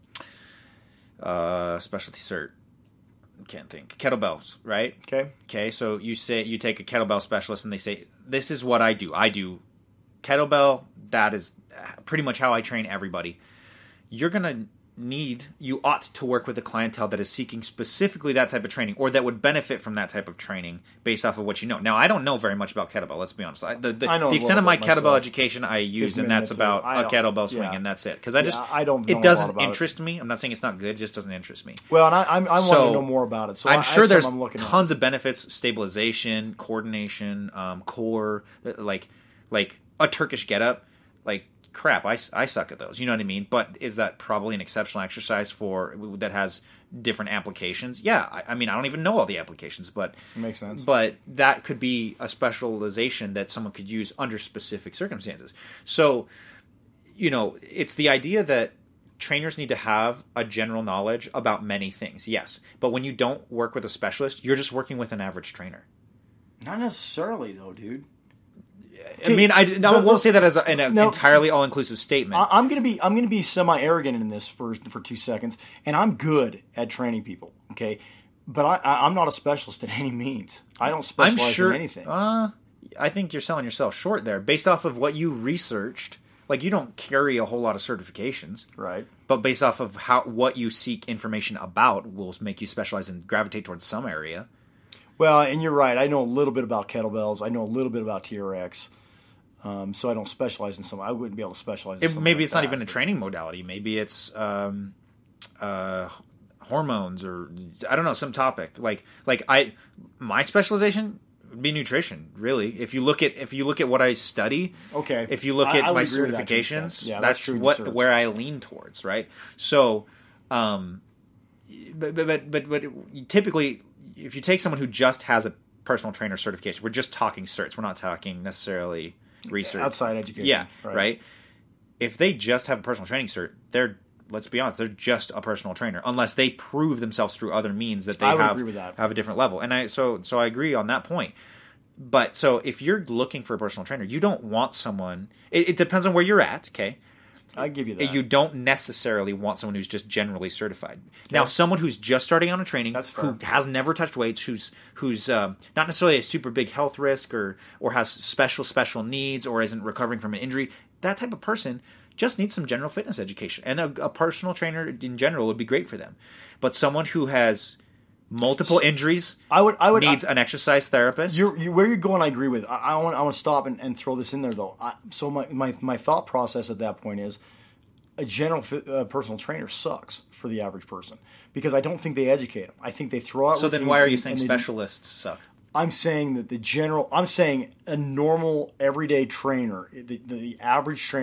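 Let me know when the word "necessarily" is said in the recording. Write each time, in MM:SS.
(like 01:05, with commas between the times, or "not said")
01:06, 02:08, 02:28, 02:35.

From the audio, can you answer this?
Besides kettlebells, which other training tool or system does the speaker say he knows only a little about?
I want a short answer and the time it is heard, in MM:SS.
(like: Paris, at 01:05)
TRX, at 01:38.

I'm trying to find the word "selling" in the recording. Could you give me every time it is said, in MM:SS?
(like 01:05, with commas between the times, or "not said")
01:23.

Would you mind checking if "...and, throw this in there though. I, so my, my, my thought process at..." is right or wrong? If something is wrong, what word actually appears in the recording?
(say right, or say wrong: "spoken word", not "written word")
right.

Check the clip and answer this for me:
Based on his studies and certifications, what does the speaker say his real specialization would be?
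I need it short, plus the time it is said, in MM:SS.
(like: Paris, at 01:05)
Nutrition, at 01:51.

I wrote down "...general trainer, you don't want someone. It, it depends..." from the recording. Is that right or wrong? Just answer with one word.
wrong.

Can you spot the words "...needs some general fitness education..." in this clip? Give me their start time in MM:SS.
02:42.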